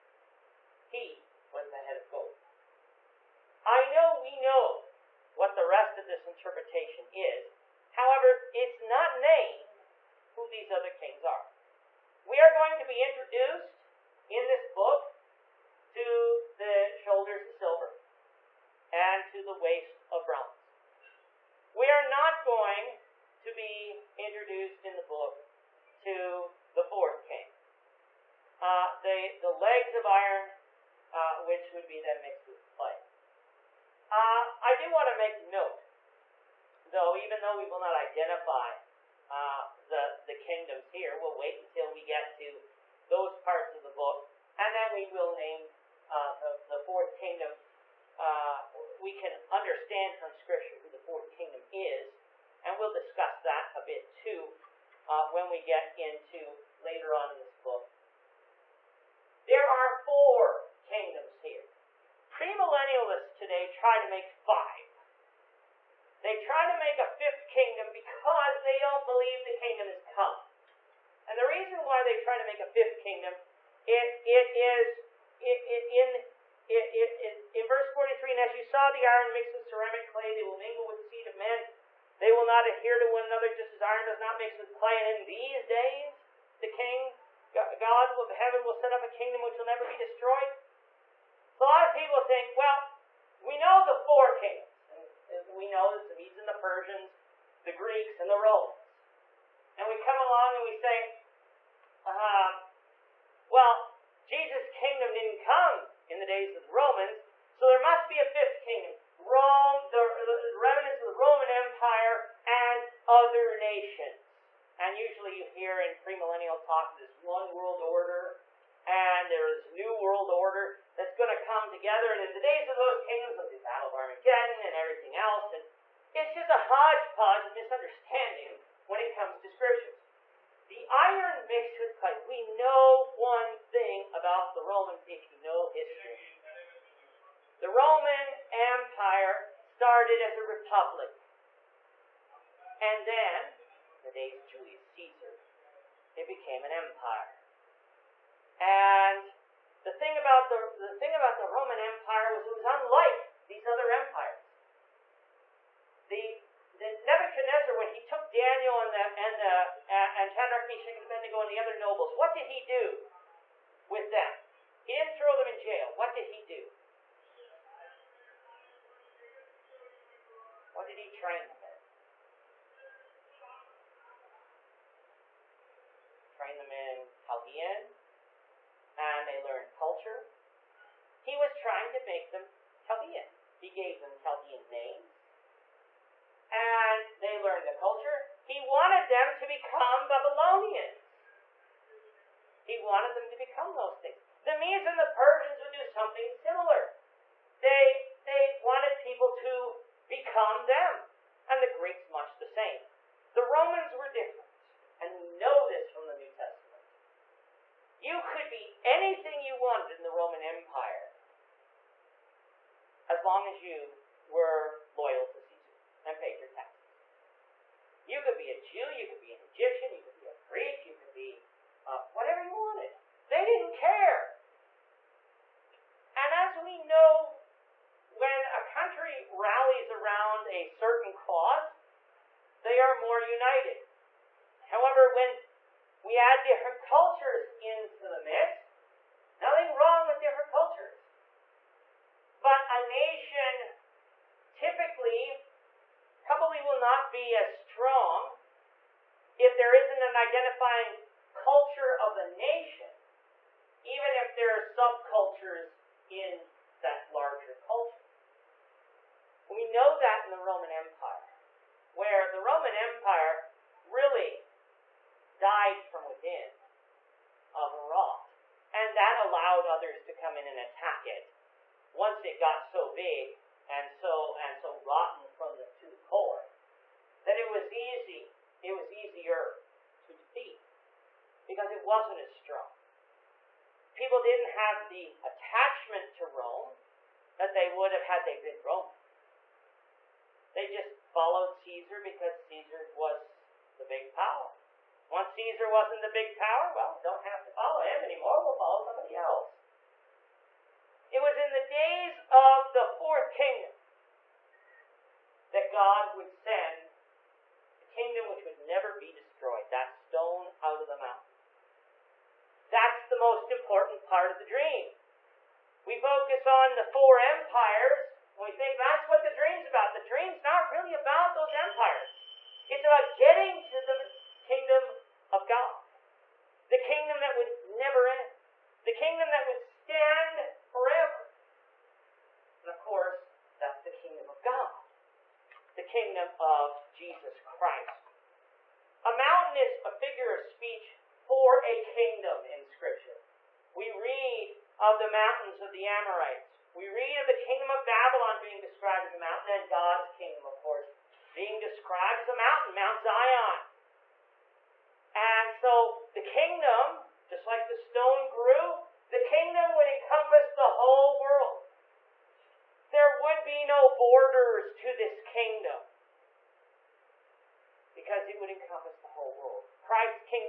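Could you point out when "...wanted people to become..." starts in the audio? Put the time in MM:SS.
03:18.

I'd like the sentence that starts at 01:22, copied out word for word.
They will not adhere to one another, just as iron does not mix with clay.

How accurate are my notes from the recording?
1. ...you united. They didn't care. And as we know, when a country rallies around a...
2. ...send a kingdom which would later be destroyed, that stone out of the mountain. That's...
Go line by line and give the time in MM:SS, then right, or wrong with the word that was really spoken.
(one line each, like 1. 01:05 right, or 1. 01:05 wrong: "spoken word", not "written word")
1. 03:42 wrong: "wanted", not "united"
2. 05:06 wrong: "never", not "later".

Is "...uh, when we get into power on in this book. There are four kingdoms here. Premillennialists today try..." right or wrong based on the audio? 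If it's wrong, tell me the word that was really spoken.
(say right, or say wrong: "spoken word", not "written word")
wrong: "later", not "power".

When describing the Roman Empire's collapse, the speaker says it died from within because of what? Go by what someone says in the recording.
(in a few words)
Rot.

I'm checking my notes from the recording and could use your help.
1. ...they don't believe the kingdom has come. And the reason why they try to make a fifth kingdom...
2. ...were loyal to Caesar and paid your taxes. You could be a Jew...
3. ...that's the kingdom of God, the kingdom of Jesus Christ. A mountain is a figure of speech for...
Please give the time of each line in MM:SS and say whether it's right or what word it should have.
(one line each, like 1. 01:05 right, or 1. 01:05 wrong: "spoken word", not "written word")
1. 01:08 right
2. 03:34 right
3. 05:33 right.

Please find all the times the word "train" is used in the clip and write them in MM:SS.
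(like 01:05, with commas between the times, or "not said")
02:51, 02:56.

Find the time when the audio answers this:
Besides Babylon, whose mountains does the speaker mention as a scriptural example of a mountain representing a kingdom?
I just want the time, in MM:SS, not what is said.
05:45.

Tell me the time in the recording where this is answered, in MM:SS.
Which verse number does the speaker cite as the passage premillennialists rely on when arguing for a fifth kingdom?
01:17.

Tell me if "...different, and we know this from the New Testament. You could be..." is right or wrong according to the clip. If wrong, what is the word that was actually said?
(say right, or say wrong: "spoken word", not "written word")
right.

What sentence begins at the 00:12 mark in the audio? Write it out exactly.
We are going to be introduced in this book to the shoulders of silver and to the waist of bronze.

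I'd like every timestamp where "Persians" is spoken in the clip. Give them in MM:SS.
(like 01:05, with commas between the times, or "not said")
01:36, 03:15.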